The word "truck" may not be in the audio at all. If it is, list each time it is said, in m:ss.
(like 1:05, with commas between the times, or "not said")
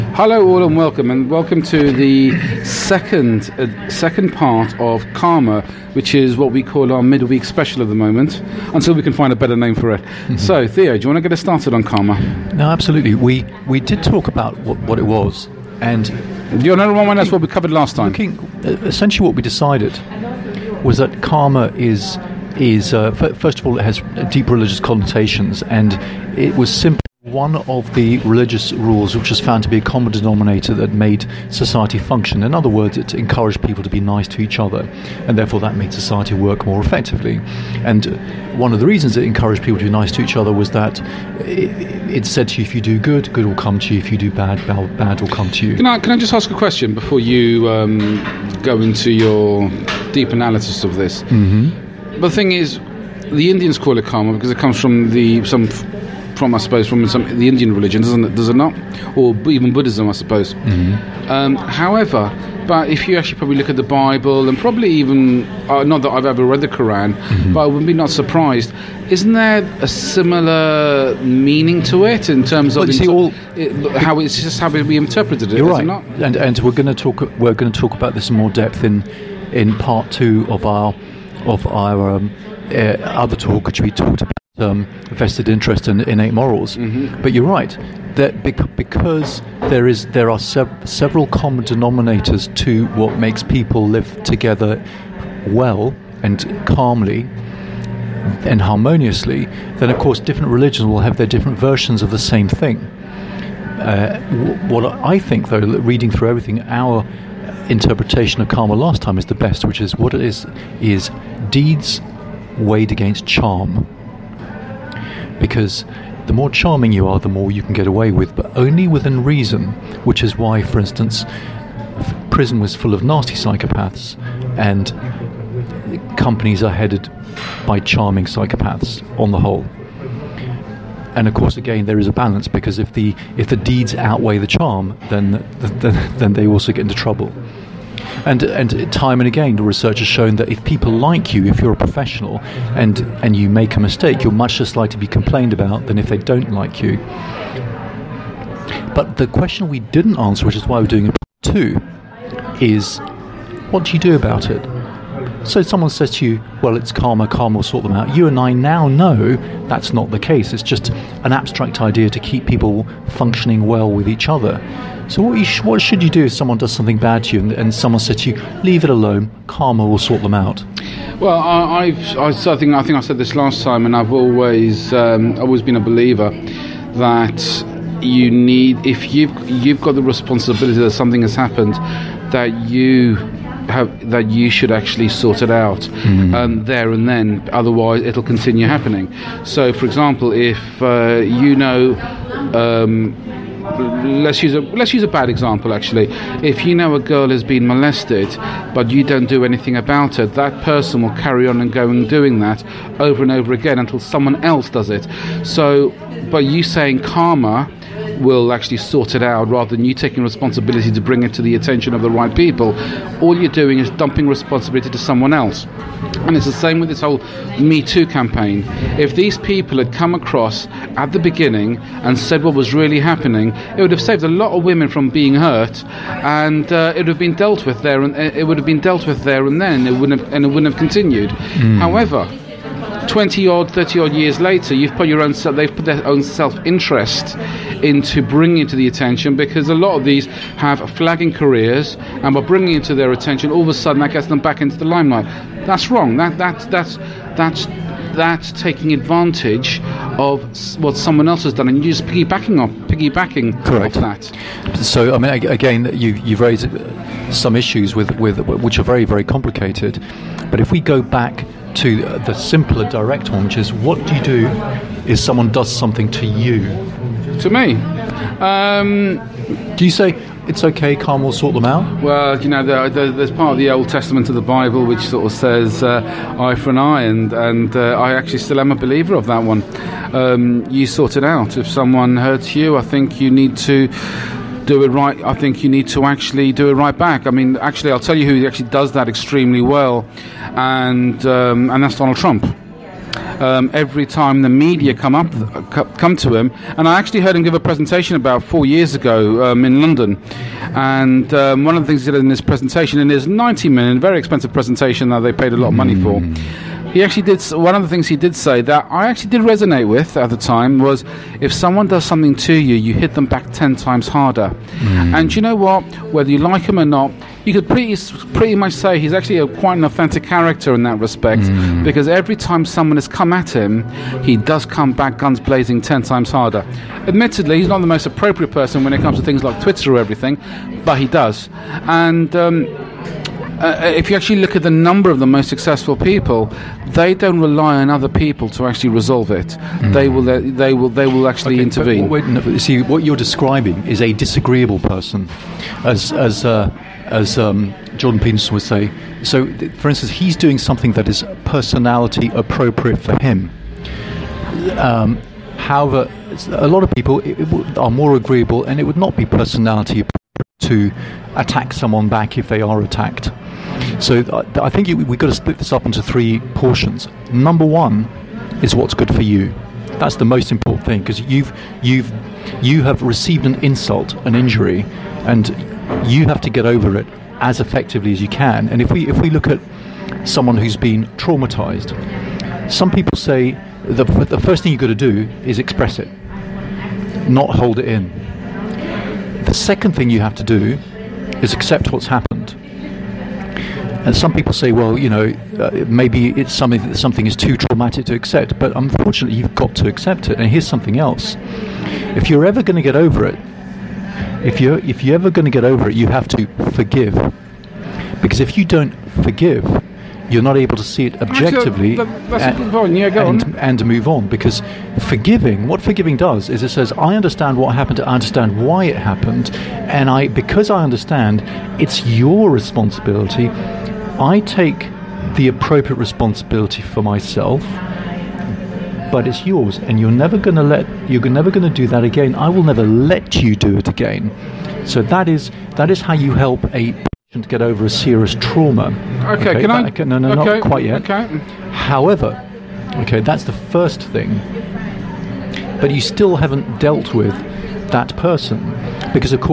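not said.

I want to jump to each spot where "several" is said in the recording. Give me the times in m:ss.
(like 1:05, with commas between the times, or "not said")
1:30.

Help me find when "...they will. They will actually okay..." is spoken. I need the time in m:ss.
5:40.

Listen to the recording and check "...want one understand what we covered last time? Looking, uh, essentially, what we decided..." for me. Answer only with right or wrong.
wrong.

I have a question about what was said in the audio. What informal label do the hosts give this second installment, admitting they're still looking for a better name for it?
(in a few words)
midweek special.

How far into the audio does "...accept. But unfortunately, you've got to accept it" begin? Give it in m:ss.
6:38.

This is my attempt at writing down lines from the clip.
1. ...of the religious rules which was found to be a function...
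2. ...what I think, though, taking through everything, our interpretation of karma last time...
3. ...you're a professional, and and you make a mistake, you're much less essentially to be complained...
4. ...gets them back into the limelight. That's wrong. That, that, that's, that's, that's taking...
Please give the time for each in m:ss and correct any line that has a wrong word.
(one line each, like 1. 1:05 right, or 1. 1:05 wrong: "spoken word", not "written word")
1. 0:27 wrong: "common", not "function"
2. 1:44 wrong: "reading", not "taking"
3. 2:21 wrong: "likely", not "essentially"
4. 4:04 right.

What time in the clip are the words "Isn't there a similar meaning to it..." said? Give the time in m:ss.
1:09.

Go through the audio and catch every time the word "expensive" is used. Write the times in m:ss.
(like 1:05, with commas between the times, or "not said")
5:04.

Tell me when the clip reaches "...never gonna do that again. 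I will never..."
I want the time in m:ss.
7:11.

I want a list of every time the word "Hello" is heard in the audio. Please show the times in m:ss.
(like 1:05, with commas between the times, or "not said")
0:00.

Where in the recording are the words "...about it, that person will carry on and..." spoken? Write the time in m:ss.
3:19.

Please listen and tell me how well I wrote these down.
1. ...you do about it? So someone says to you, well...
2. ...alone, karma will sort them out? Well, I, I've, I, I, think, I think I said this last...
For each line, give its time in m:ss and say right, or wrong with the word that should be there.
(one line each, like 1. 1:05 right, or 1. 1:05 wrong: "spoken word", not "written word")
1. 2:33 right
2. 2:48 right.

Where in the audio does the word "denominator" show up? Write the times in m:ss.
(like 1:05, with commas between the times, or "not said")
0:30, 1:31.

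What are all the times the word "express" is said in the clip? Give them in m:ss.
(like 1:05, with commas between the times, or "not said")
6:25.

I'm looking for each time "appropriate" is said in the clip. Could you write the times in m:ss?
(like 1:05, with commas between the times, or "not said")
5:28, 5:52, 5:59, 7:05.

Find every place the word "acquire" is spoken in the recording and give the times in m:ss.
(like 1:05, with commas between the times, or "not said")
not said.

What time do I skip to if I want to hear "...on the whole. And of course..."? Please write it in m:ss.
2:09.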